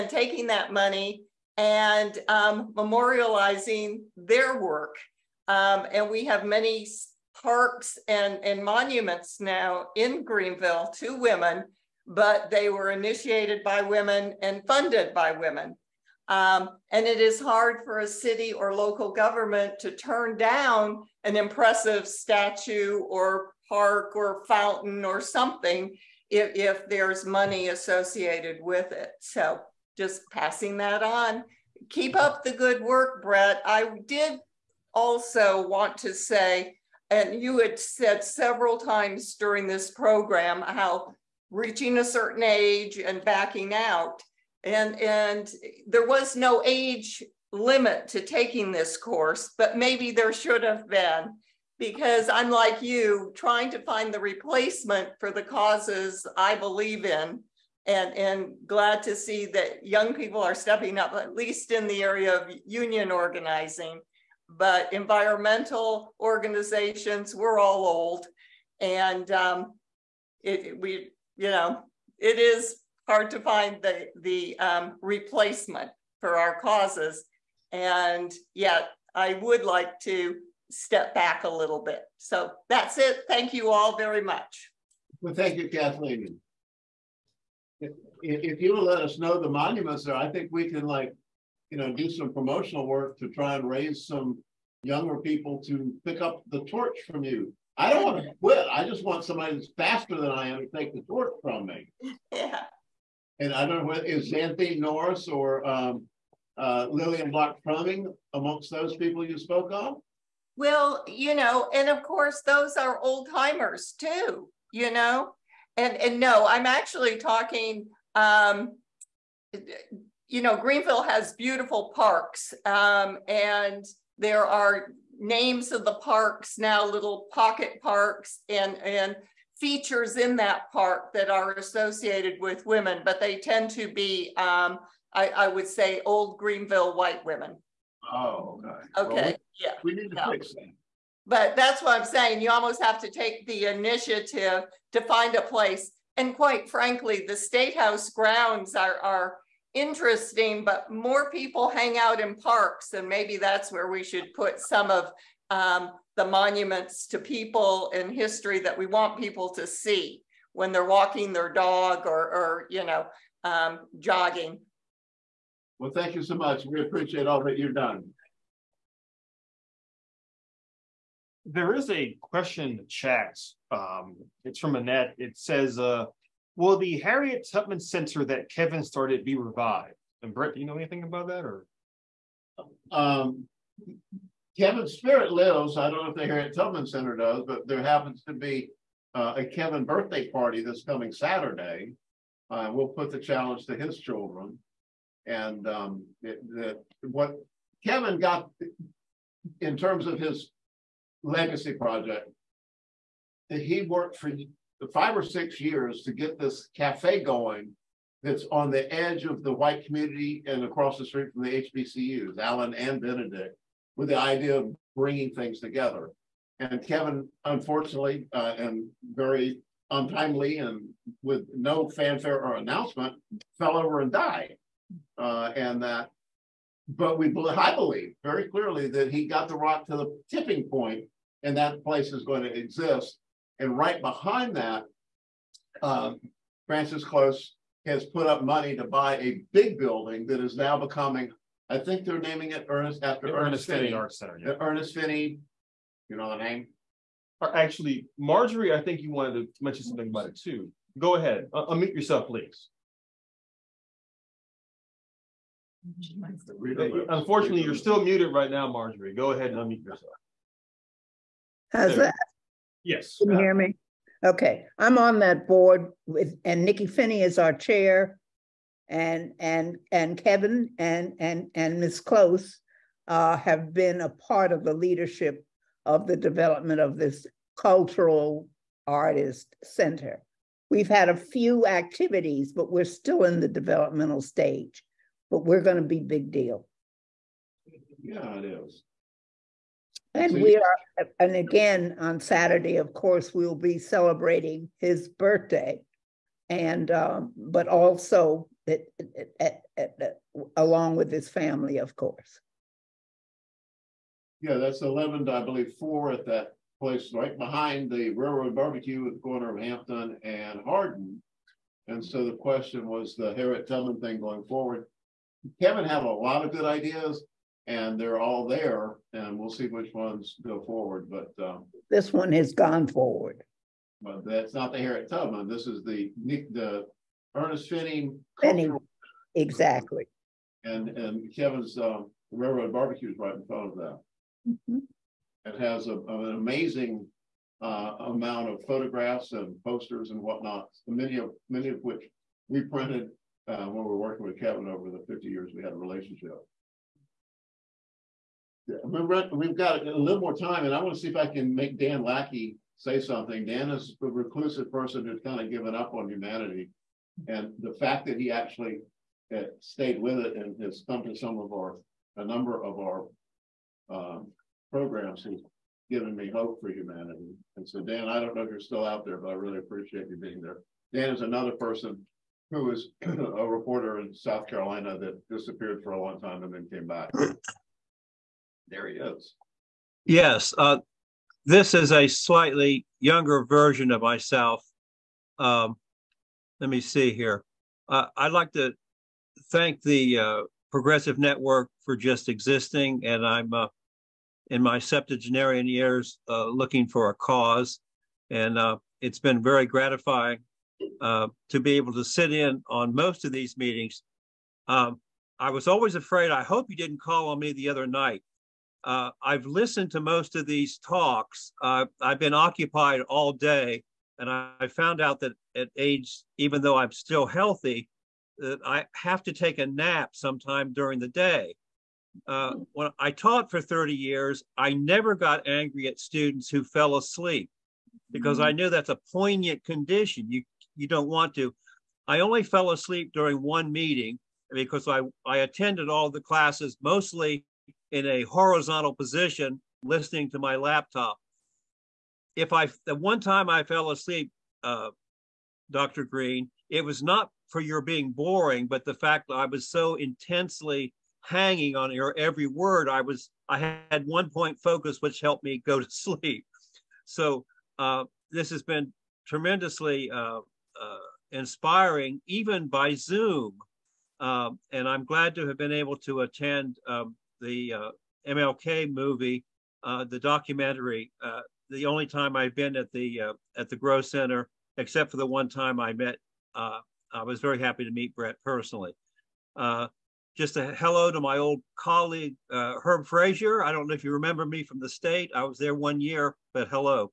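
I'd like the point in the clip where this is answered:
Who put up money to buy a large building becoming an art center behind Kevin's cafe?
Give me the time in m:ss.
3:56.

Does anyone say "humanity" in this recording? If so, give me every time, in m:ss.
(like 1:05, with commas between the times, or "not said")
5:56, 6:06.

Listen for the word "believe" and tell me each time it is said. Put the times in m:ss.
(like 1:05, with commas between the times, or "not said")
0:56, 3:47, 5:05.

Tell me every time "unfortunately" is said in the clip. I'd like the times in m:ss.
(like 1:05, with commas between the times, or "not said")
3:37, 4:17.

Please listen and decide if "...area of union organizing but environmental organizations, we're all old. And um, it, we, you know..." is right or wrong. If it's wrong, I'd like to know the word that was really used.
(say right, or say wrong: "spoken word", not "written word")
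right.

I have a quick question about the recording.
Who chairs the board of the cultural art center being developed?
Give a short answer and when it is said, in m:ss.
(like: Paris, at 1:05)
Nikki Finney, at 4:26.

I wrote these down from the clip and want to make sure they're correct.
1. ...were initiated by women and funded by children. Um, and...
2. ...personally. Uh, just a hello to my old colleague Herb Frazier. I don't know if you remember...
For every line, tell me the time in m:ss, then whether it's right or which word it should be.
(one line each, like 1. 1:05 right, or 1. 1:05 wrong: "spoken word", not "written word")
1. 0:12 wrong: "women", not "children"
2. 7:58 right.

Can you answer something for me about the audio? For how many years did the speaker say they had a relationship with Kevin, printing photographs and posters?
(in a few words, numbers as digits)
50.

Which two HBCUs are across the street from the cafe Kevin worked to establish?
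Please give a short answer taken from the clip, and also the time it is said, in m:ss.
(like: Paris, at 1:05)
Allen and Benedict, at 3:32.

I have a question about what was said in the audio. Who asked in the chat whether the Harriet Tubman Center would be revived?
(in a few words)
Annette.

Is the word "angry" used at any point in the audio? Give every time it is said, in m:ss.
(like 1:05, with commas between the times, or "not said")
7:05.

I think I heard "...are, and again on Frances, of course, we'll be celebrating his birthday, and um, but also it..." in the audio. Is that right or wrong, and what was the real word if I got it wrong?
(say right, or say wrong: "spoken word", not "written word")
wrong: "Saturday", not "Frances".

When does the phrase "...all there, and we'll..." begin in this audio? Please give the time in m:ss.
5:18.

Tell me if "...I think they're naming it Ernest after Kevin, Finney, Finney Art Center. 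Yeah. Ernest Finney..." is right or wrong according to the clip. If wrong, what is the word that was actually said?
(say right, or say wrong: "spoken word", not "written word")
wrong: "Ernest", not "Kevin".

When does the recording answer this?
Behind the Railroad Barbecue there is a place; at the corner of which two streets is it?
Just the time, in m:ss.
5:09.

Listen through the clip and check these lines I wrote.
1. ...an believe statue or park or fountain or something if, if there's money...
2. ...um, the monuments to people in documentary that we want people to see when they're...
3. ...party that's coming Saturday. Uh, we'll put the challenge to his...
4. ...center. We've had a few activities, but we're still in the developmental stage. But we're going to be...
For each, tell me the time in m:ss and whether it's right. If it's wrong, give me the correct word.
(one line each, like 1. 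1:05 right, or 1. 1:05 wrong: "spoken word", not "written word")
1. 0:21 wrong: "impressive", not "believe"
2. 2:35 wrong: "history", not "documentary"
3. 3:10 right
4. 4:39 right.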